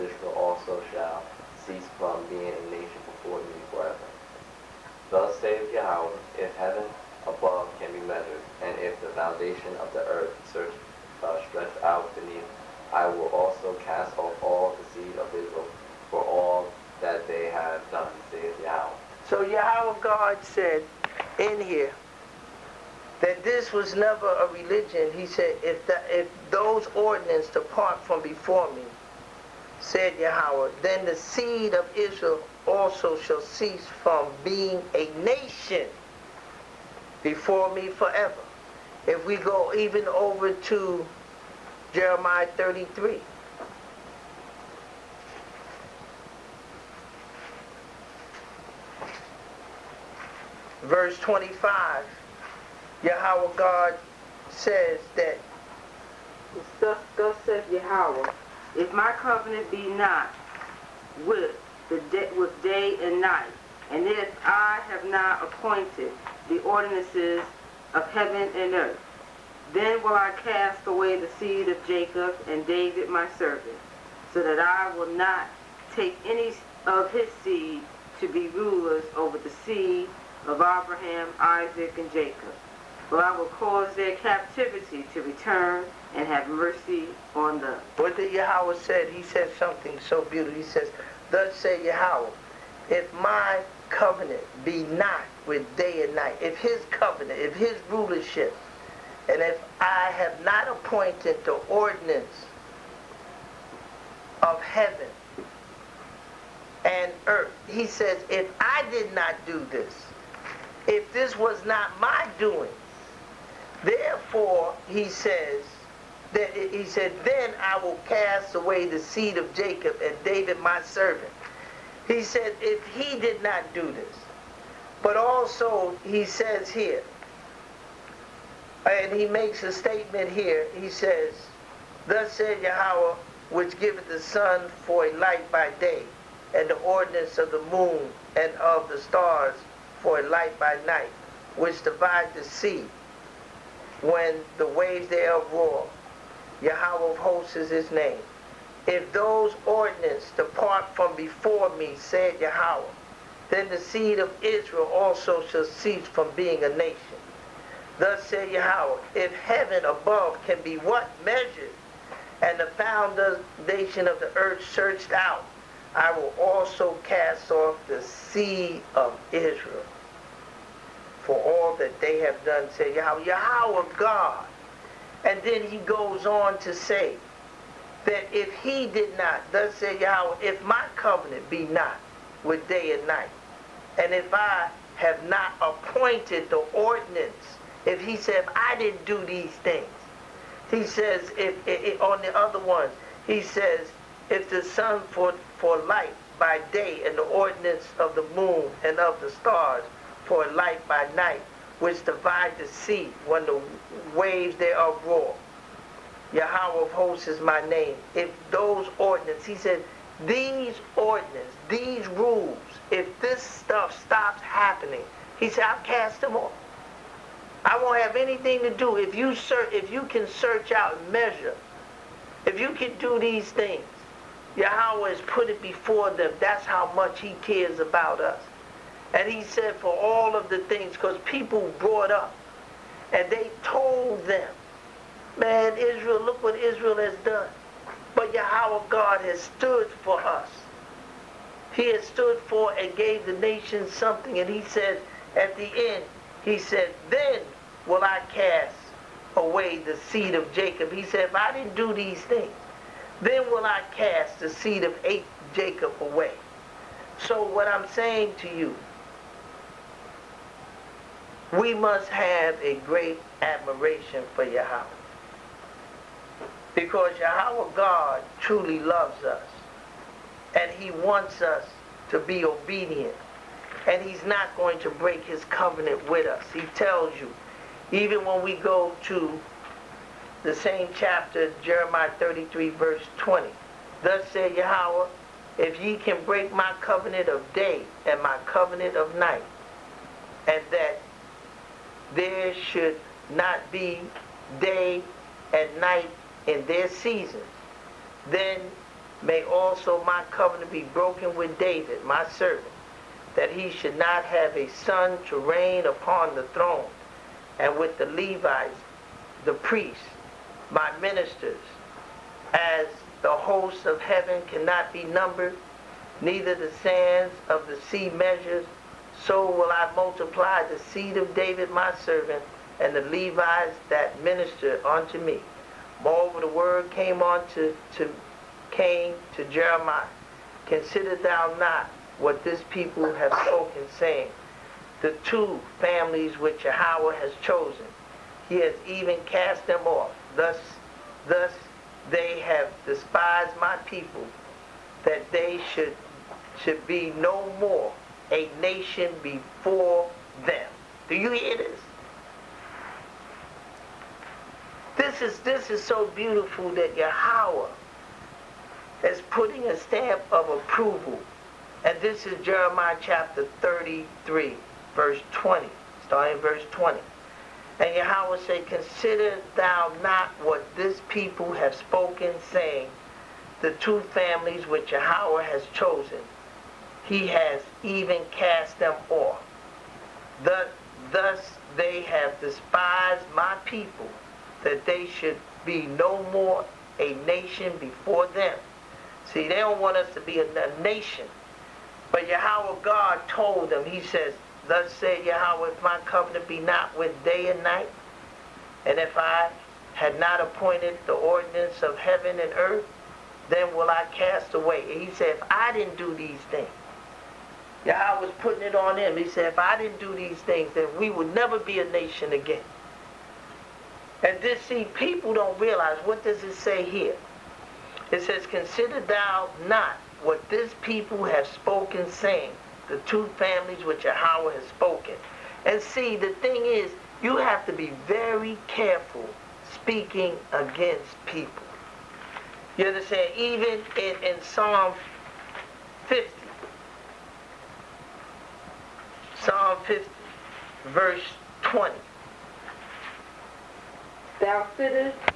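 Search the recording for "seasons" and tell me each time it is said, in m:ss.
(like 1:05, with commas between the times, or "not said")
4:56.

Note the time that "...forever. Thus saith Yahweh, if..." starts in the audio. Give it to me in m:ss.
0:03.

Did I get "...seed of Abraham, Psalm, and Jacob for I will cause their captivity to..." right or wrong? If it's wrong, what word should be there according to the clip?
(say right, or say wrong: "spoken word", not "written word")
wrong: "Isaac", not "Psalm".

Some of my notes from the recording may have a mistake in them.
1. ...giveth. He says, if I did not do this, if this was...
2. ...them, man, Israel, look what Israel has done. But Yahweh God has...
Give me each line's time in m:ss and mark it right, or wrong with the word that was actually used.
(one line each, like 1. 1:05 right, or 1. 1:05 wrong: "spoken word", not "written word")
1. 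1:47 wrong: "earth", not "giveth"
2. 3:54 right.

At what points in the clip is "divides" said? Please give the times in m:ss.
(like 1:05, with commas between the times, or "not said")
2:21, 3:22.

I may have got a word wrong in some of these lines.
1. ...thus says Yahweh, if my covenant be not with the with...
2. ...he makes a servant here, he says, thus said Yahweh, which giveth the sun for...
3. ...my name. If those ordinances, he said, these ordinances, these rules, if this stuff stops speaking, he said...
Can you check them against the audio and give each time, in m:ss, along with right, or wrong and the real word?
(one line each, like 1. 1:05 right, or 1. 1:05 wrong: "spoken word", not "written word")
1. 0:57 right
2. 2:09 wrong: "statement", not "servant"
3. 3:27 wrong: "happening", not "speaking".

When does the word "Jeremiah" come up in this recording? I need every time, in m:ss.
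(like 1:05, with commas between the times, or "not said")
0:41, 4:41, 5:29, 6:02.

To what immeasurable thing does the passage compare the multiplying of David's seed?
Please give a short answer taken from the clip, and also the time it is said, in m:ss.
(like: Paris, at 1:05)
the sands of the sea, at 5:16.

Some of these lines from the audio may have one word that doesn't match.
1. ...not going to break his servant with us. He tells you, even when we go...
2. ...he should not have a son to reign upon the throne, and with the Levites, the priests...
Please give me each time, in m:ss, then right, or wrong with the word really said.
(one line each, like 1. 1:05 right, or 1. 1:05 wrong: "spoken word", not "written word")
1. 4:34 wrong: "covenant", not "servant"
2. 5:03 right.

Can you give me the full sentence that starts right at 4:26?
Because Yahweh God truly loves us.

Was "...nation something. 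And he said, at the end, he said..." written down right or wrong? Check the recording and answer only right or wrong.
right.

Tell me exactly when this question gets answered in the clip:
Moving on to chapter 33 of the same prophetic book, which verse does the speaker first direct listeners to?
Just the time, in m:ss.
0:50.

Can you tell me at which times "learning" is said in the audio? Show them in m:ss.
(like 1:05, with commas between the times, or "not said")
not said.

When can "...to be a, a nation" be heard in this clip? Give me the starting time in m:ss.
6:30.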